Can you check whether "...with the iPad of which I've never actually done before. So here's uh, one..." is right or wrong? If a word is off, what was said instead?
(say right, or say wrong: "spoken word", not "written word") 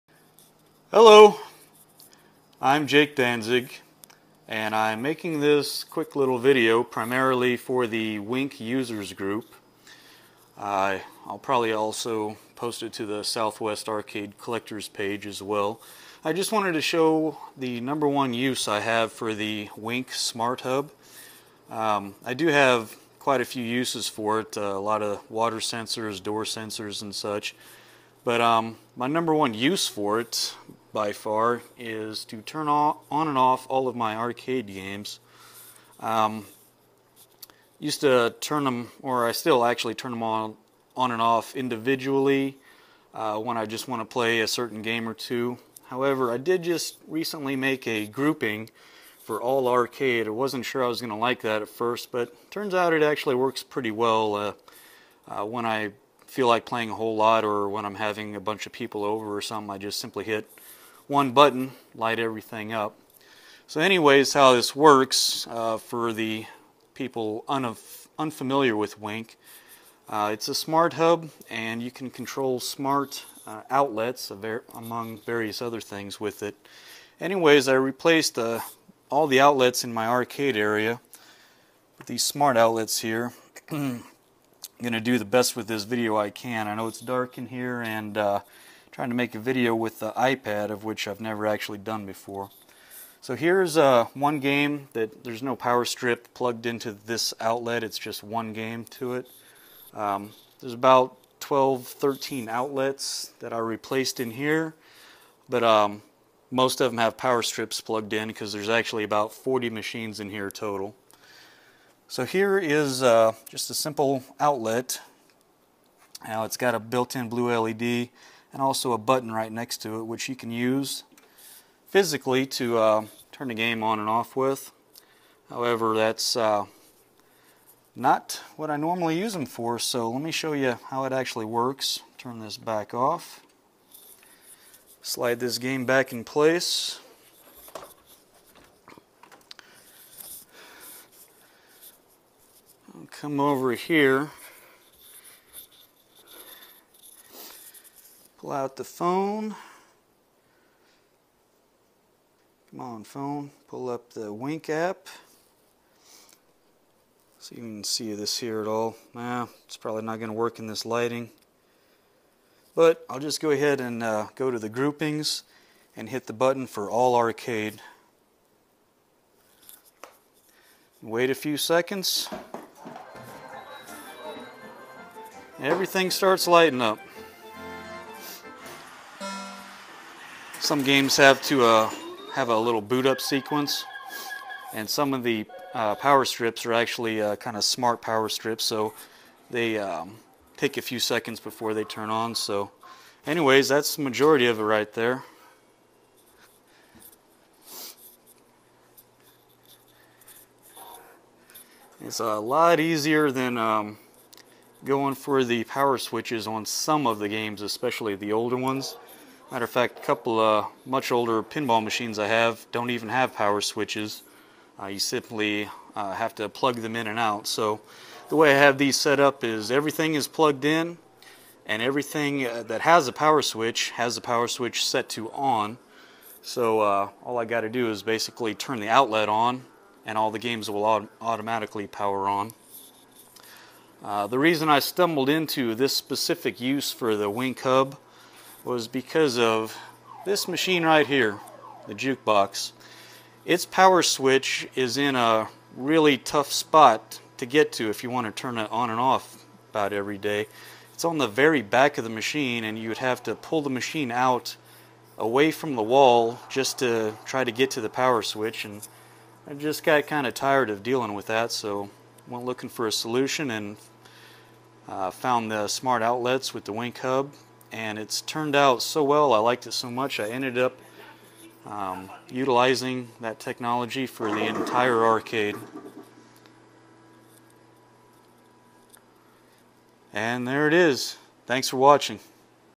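right.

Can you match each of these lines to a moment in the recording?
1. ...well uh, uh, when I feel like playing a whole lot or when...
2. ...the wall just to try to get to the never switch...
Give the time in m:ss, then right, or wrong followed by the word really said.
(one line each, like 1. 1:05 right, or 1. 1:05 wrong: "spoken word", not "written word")
1. 0:53 right
2. 4:15 wrong: "power", not "never".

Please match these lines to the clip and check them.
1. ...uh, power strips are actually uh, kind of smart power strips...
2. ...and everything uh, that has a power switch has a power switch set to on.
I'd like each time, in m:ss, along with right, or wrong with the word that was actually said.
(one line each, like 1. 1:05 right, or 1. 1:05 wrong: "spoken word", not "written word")
1. 3:05 right
2. 3:41 right.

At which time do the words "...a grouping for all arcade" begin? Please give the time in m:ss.
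0:47.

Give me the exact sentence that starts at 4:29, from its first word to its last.
I liked it so much I ended up um, utilizing that technology for the entire arcade.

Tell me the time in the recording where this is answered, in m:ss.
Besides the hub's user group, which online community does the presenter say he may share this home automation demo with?
0:13.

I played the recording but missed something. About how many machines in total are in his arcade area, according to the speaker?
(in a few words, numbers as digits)
40.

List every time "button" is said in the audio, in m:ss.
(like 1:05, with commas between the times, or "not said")
1:01, 1:58, 2:46.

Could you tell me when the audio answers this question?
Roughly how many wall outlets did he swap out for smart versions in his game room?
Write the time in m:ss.
1:41.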